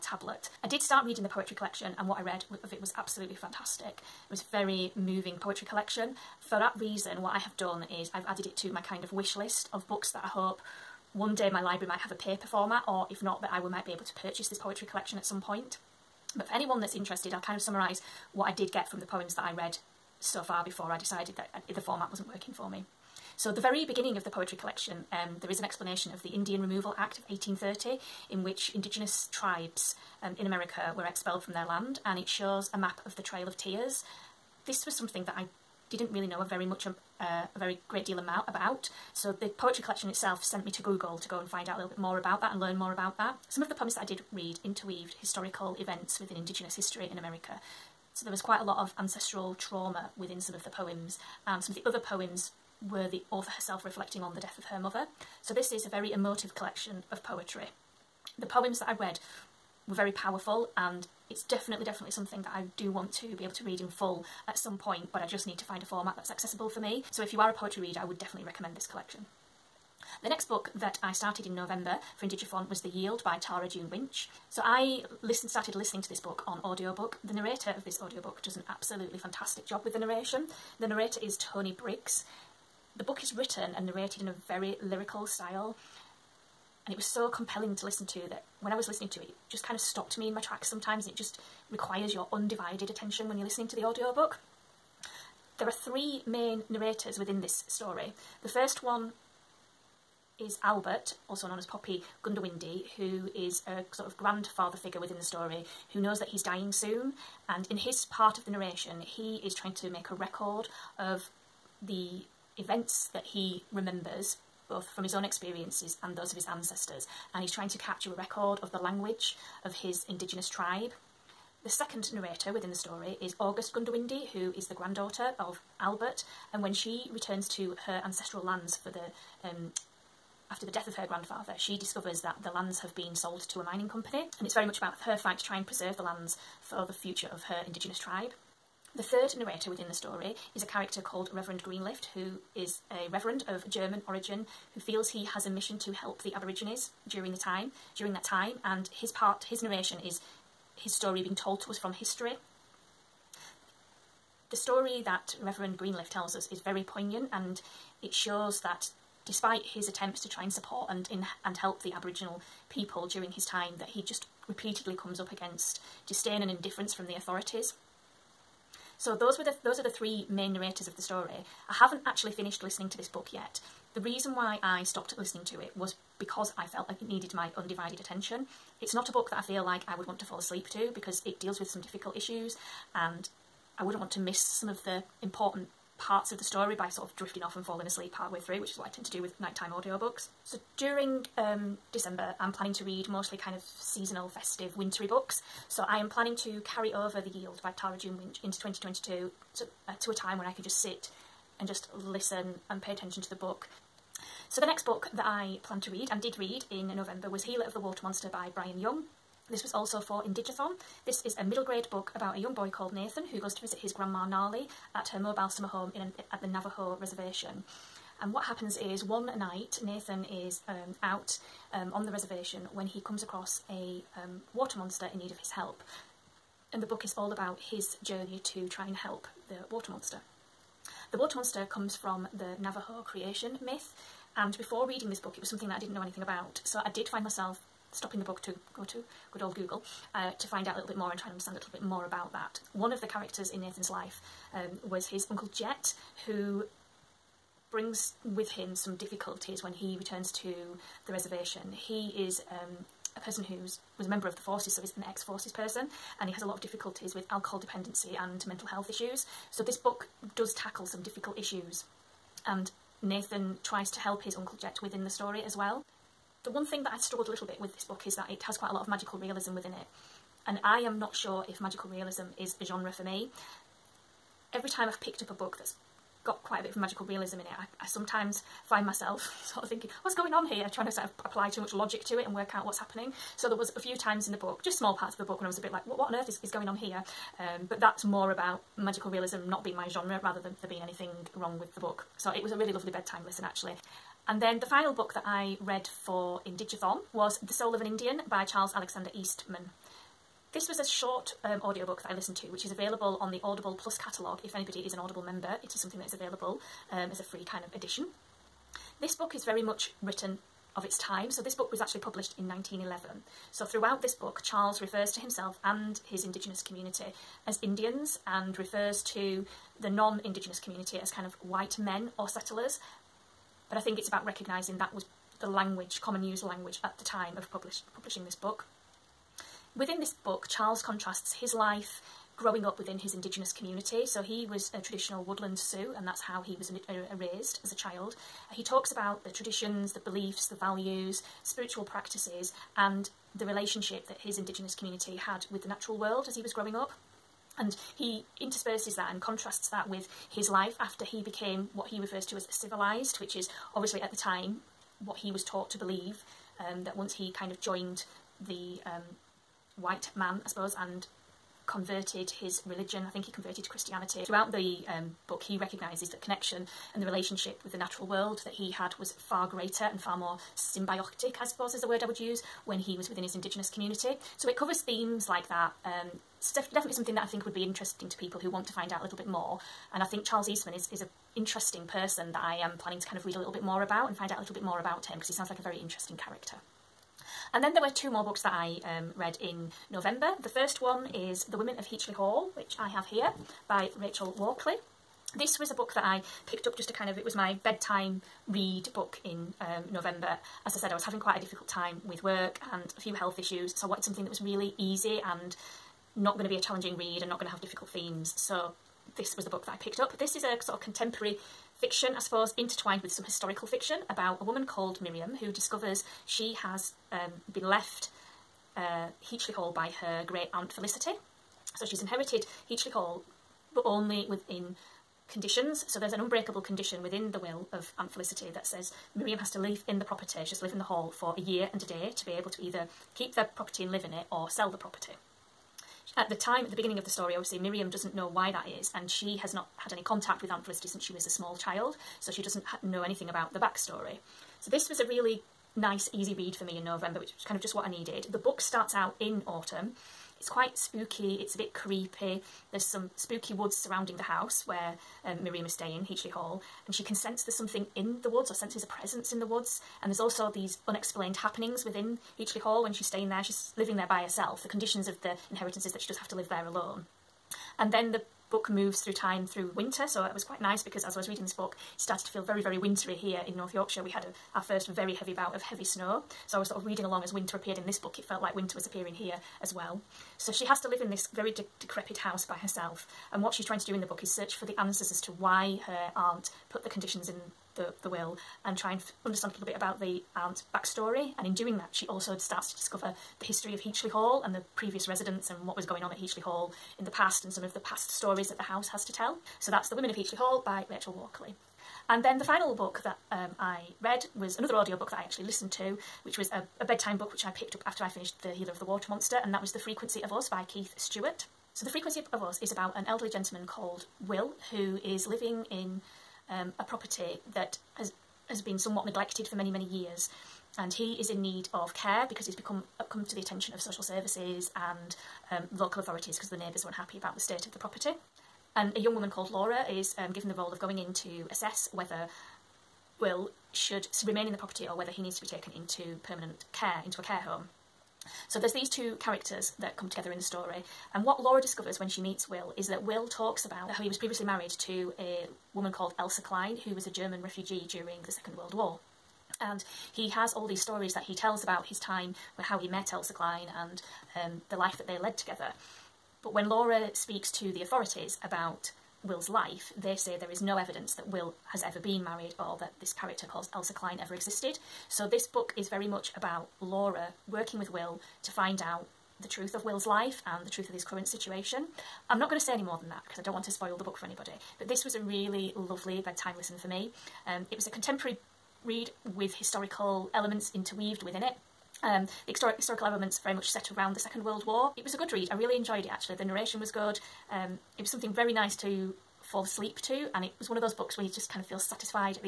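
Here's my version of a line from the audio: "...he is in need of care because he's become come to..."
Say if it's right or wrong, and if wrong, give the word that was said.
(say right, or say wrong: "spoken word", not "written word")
right.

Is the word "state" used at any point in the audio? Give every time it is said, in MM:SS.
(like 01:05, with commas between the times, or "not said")
08:47.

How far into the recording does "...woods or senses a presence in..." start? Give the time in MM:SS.
07:38.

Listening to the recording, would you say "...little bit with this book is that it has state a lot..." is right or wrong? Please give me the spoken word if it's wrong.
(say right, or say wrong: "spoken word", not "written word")
wrong: "quite", not "state".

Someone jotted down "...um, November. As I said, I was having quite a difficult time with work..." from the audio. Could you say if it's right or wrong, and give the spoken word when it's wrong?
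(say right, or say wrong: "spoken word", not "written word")
right.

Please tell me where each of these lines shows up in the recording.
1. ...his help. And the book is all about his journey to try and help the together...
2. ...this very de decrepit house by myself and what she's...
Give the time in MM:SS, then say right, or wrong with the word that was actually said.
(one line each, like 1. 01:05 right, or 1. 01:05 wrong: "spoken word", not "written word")
1. 03:45 wrong: "water", not "together"
2. 08:01 wrong: "herself", not "myself".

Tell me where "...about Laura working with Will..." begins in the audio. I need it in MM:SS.
09:26.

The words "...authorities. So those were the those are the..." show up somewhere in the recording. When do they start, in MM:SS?
02:47.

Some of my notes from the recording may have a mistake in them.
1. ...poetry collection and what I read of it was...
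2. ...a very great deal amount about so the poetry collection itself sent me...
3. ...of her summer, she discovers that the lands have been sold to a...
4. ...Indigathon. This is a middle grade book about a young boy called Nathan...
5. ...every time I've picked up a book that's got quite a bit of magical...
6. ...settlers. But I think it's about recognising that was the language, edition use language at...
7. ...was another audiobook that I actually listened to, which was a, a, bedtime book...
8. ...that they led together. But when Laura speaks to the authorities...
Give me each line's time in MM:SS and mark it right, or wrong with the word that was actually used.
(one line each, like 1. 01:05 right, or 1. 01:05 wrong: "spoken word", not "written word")
1. 00:01 right
2. 00:37 right
3. 02:10 wrong: "grandfather", not "summer"
4. 03:30 right
5. 04:34 right
6. 05:22 wrong: "common", not "edition"
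7. 08:24 right
8. 09:14 right.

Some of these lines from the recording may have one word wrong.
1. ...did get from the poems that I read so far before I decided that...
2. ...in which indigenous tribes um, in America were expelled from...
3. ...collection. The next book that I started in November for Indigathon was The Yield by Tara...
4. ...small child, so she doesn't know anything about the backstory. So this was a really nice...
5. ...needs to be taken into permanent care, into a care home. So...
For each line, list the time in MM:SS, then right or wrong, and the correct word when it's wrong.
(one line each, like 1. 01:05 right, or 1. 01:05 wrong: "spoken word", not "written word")
1. 00:18 right
2. 00:28 right
3. 01:08 right
4. 07:21 right
5. 08:55 right.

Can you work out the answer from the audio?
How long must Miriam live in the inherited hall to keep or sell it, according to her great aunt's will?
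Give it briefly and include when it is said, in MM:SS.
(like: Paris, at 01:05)
A year and a day, at 07:11.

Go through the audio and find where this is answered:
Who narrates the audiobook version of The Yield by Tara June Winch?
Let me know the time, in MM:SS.
01:21.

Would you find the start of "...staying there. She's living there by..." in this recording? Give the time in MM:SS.
07:43.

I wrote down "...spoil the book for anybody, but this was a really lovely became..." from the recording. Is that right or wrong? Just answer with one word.
wrong.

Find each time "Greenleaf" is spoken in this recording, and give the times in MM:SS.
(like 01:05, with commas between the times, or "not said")
02:21, 02:35.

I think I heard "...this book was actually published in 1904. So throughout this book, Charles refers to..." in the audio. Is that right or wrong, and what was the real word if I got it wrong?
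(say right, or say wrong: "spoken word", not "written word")
wrong: "1911", not "1904".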